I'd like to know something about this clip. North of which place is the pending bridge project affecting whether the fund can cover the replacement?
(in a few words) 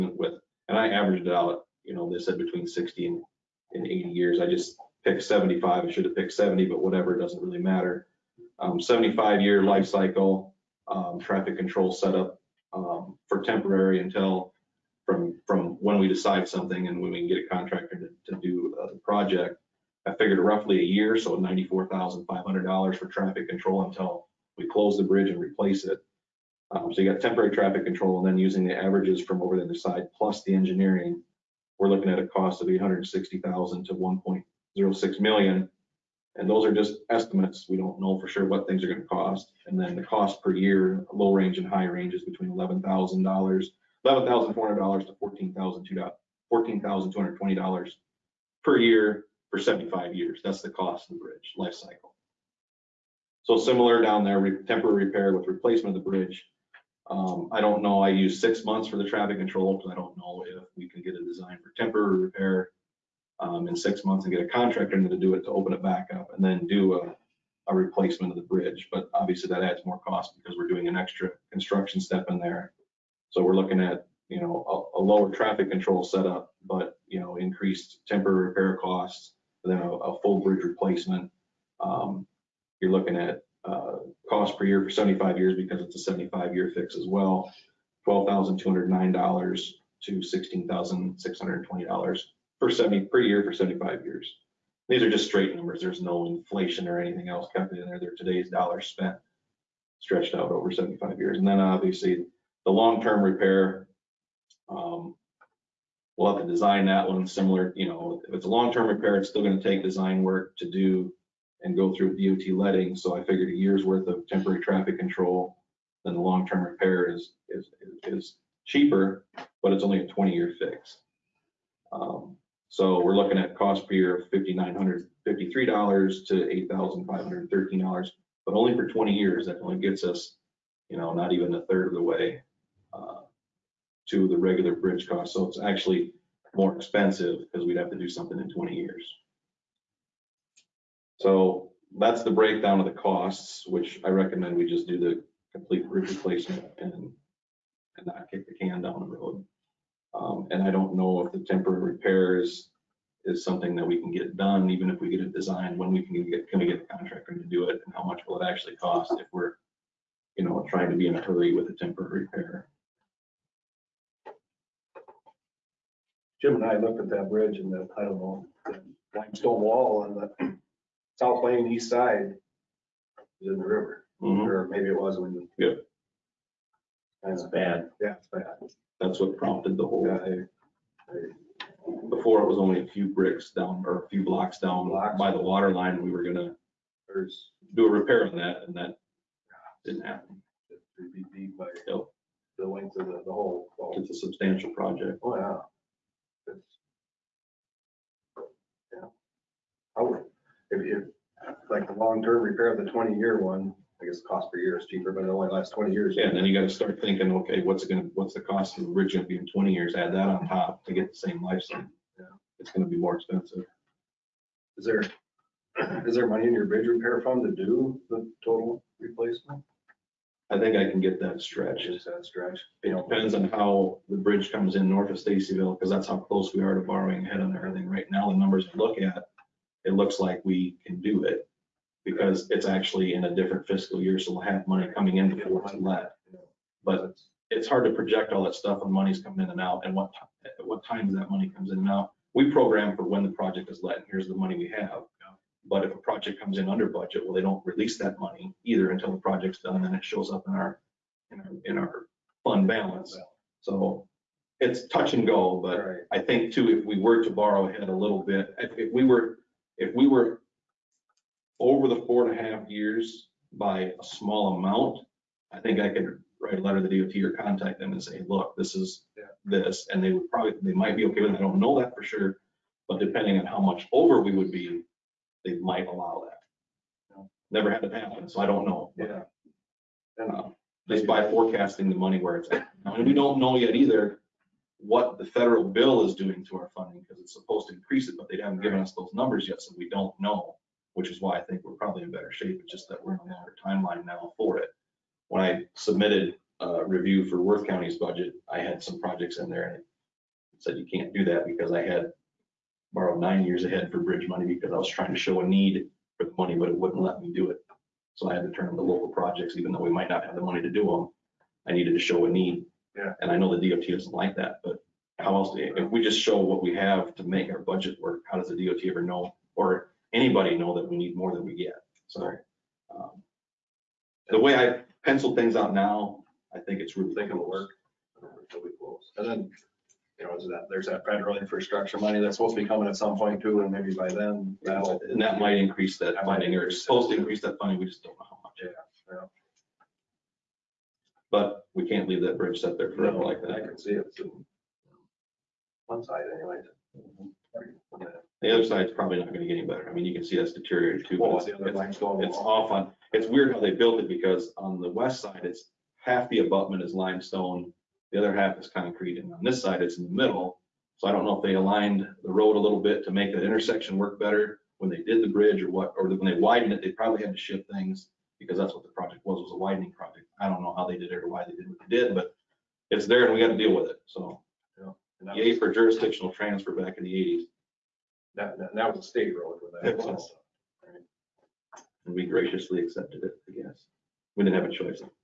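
Stacyville.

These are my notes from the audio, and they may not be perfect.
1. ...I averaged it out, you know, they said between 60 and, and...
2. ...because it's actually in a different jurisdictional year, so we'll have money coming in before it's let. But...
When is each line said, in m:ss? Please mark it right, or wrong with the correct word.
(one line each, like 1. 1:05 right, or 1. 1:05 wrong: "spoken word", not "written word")
1. 0:00 right
2. 3:52 wrong: "fiscal", not "jurisdictional".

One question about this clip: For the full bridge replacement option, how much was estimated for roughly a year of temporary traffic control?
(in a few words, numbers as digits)
$94,500.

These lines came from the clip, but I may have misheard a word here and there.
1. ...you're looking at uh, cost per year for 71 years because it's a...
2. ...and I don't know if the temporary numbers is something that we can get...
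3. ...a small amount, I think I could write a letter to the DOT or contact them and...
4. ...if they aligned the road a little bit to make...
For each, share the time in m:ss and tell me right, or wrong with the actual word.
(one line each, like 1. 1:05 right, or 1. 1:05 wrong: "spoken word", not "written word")
1. 1:22 wrong: "75", not "71"
2. 2:30 wrong: "repairs", not "numbers"
3. 4:23 right
4. 6:01 right.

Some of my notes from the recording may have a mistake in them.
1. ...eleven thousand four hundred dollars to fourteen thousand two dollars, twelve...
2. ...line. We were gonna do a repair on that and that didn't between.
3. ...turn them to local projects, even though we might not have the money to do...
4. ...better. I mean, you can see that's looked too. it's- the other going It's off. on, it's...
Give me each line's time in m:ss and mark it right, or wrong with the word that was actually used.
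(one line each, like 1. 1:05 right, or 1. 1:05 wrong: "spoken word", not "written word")
1. 0:44 wrong: "fourteen", not "twelve"
2. 3:05 wrong: "happen", not "between"
3. 5:08 right
4. 5:49 wrong: "deteriorated", not "looked".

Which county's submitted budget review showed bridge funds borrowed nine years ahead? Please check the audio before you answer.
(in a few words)
Worth County.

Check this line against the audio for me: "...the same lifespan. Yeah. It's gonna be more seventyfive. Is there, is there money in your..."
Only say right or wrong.
wrong.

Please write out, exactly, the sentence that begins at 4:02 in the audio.
We program for when the project is let, and here's the money we have.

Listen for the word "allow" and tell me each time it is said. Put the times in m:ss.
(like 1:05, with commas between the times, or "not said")
4:35.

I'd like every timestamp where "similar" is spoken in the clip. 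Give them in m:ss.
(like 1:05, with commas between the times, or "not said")
0:53, 1:47.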